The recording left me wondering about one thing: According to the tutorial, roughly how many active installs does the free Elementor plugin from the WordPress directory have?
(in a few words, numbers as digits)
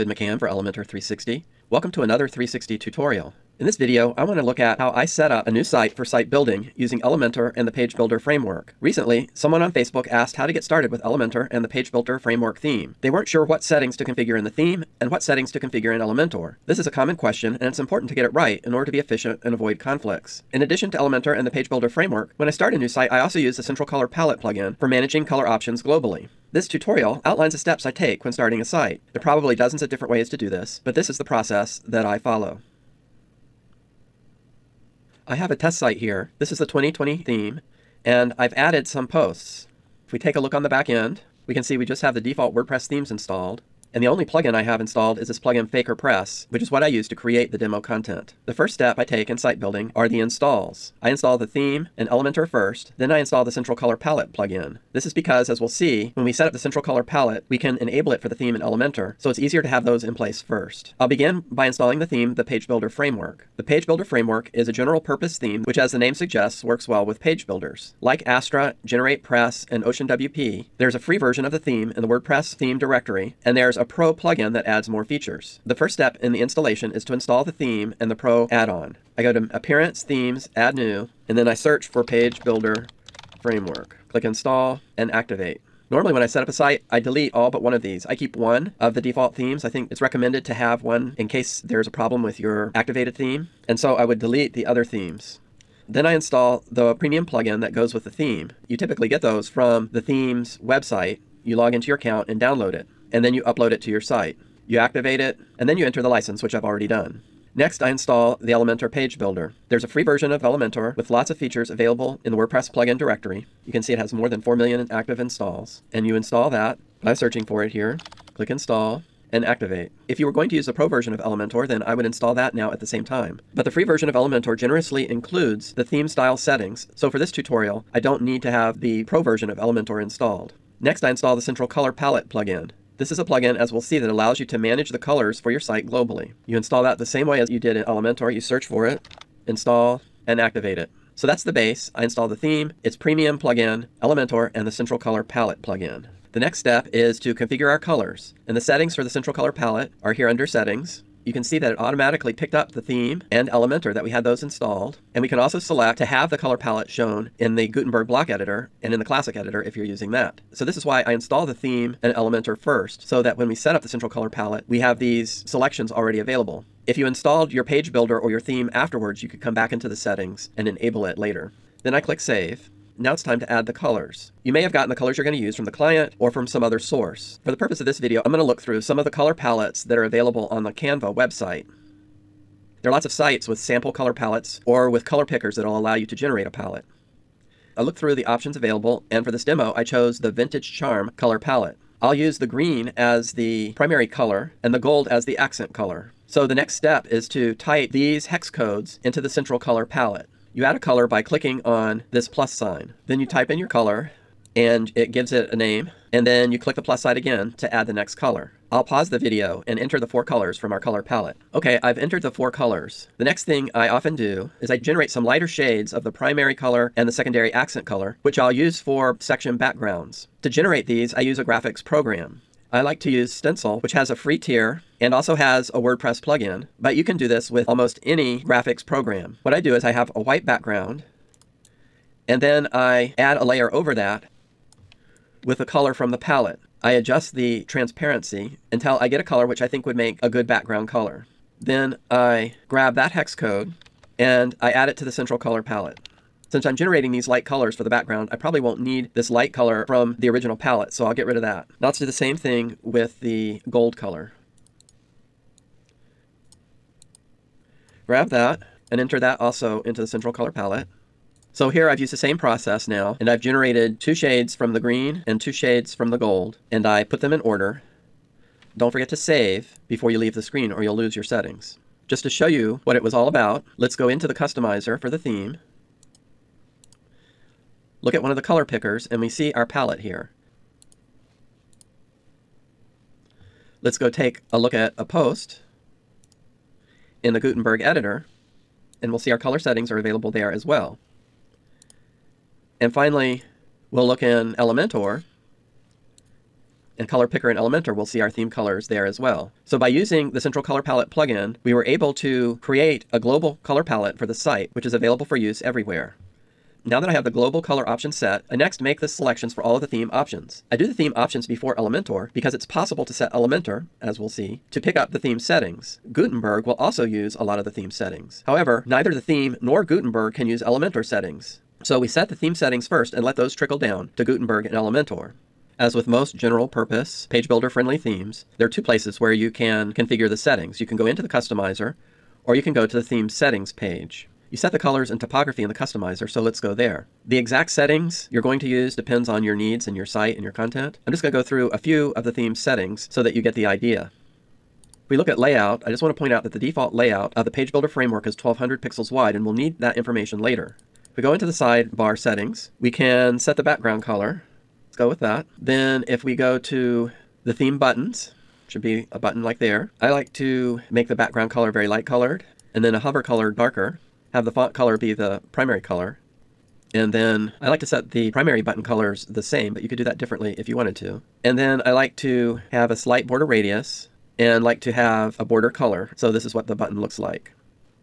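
more than 4 million.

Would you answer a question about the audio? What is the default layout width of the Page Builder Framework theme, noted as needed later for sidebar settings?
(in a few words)
1200 pixels.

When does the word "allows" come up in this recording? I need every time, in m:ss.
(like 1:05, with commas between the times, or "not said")
2:14, 3:05.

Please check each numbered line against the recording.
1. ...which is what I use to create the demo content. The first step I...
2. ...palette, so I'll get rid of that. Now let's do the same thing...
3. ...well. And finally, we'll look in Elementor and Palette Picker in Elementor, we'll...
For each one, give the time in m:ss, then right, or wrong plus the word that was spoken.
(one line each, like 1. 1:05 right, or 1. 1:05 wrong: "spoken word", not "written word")
1. 0:46 right
2. 4:10 right
3. 4:50 wrong: "Color", not "Palette".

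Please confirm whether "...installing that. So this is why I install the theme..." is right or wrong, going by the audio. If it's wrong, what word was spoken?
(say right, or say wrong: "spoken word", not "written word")
wrong: "using", not "installing".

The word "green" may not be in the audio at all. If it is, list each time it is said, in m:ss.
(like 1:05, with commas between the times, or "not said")
3:12, 4:24.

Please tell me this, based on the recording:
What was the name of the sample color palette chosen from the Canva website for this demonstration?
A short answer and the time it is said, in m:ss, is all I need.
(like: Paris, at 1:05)
Vintage Charm, at 3:10.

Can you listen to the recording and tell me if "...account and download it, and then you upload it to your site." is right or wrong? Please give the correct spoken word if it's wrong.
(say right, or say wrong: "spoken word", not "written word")
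right.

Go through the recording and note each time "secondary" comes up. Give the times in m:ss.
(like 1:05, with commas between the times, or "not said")
3:37.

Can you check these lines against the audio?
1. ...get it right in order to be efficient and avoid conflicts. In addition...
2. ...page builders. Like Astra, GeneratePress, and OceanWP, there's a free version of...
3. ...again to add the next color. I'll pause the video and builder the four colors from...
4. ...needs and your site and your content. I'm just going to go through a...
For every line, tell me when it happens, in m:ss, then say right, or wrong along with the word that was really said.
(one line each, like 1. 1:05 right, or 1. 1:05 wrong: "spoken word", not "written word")
1. 0:18 right
2. 1:07 right
3. 3:27 wrong: "enter", not "builder"
4. 5:39 right.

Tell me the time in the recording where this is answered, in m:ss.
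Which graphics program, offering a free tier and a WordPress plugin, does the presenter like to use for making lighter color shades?
3:43.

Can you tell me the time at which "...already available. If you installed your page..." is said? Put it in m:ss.
2:45.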